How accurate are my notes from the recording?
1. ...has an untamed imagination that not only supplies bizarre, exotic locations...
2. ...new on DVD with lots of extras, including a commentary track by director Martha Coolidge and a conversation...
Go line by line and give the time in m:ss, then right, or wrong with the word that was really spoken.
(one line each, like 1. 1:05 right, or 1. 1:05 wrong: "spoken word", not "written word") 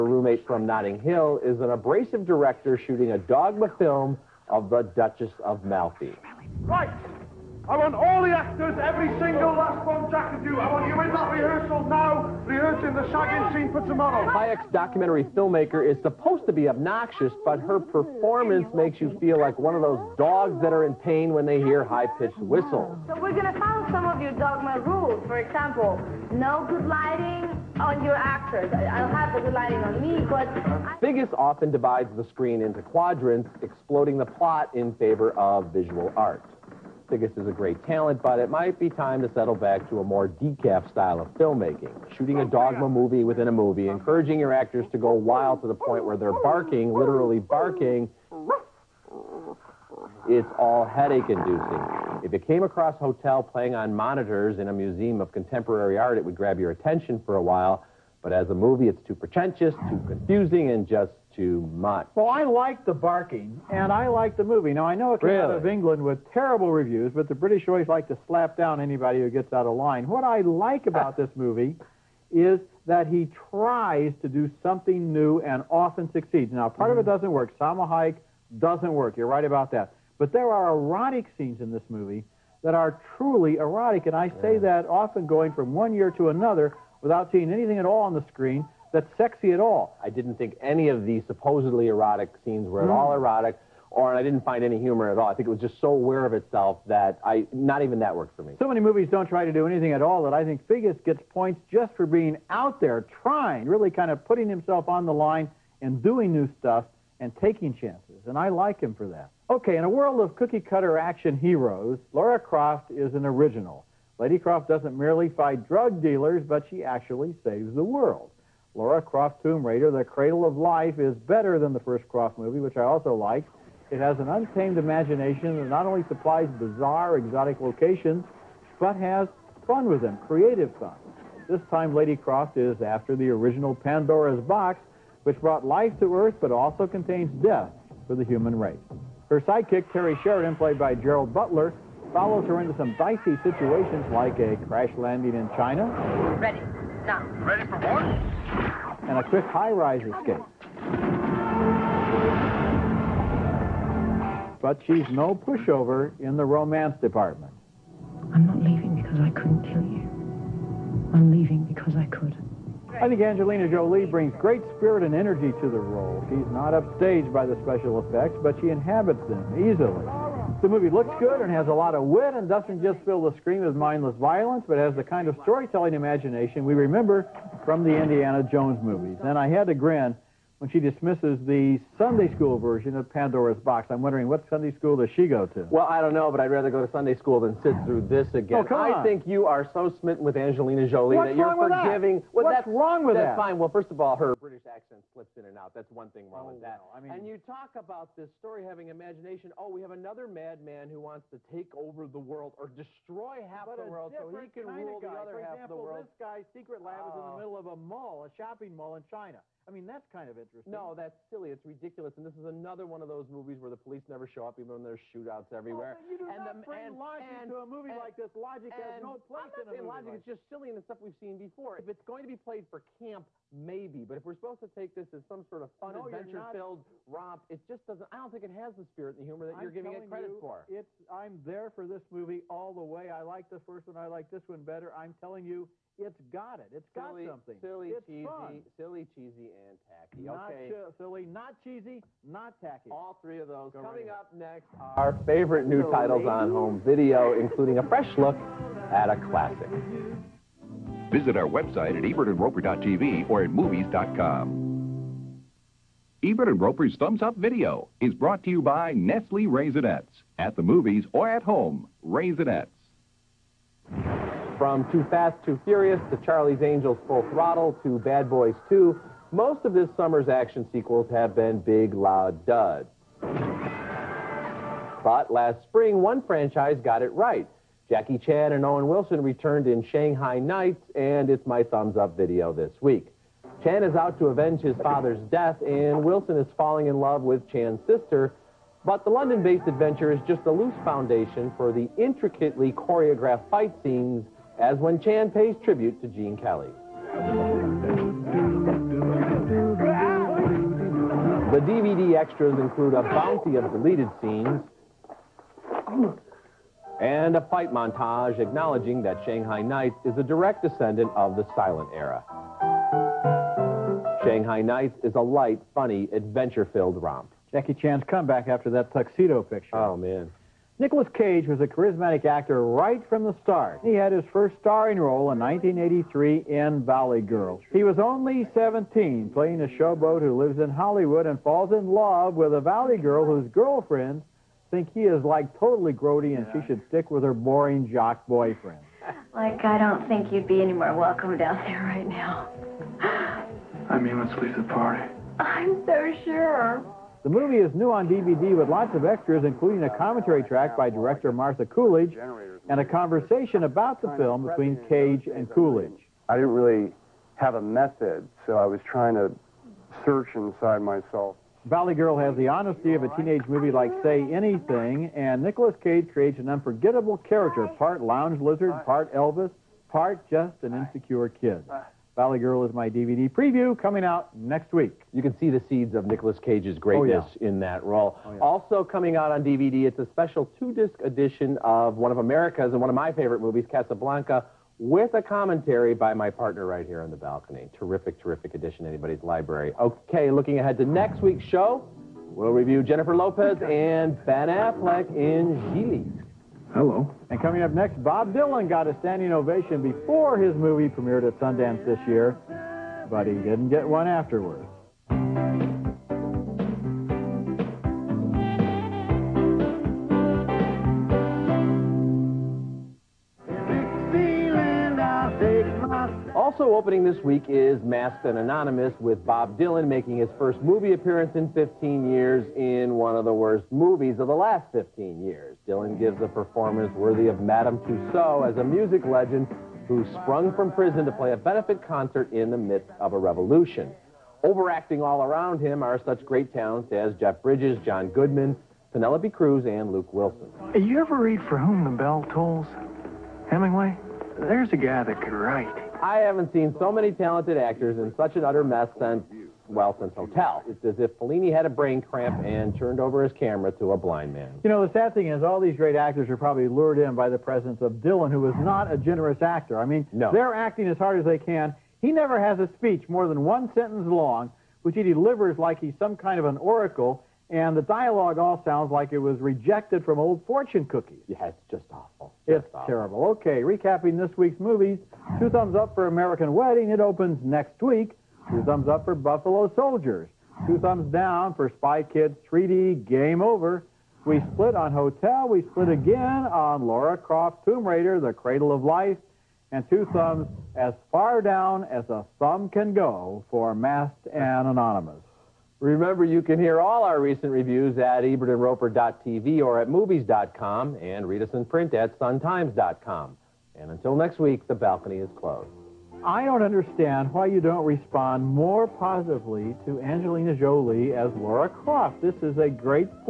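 1. 2:03 right
2. 5:47 right.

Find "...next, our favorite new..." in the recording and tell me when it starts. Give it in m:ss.
4:04.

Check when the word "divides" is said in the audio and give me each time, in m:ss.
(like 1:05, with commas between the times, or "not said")
0:31.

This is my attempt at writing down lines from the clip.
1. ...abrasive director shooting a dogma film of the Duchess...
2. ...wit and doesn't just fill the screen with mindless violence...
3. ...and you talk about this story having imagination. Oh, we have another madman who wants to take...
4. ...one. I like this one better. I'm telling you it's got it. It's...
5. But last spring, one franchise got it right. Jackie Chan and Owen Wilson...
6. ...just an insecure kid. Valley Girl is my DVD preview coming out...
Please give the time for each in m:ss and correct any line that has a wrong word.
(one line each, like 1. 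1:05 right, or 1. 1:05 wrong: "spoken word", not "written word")
1. 0:01 right
2. 2:52 right
3. 3:17 right
4. 3:53 right
5. 4:33 right
6. 6:10 right.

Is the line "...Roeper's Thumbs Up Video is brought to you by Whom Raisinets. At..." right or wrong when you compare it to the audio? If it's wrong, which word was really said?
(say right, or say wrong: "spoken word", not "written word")
wrong: "Nestle", not "Whom".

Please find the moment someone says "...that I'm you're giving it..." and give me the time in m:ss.
3:49.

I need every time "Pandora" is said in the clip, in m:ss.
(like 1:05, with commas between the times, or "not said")
2:13, 3:03.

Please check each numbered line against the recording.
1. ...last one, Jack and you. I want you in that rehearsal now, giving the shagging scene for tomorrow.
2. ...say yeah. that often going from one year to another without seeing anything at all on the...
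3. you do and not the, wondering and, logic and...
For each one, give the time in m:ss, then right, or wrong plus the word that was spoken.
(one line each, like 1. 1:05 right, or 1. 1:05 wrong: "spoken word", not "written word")
1. 0:09 wrong: "rehearsing", not "giving"
2. 1:24 right
3. 3:36 wrong: "bring", not "wondering".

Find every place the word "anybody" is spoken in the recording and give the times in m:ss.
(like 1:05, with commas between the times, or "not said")
1:08, 6:28.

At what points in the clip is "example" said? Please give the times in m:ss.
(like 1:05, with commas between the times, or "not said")
0:25, 3:25.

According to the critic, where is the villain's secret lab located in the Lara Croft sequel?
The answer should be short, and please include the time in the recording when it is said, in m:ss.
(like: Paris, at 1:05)
A shopping mall in China, at 3:28.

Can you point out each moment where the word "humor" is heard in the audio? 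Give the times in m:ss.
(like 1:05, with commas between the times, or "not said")
1:34, 3:49.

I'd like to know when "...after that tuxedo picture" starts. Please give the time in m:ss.
5:18.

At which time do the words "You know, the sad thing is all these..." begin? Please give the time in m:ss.
7:34.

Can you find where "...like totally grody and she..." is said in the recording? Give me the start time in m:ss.
5:35.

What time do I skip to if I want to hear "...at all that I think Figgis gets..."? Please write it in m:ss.
1:39.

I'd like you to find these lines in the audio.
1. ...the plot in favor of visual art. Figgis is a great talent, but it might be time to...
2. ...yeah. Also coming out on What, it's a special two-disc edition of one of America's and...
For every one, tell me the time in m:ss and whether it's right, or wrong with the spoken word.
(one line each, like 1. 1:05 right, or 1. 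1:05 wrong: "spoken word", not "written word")
1. 0:34 right
2. 6:18 wrong: "DVD", not "What".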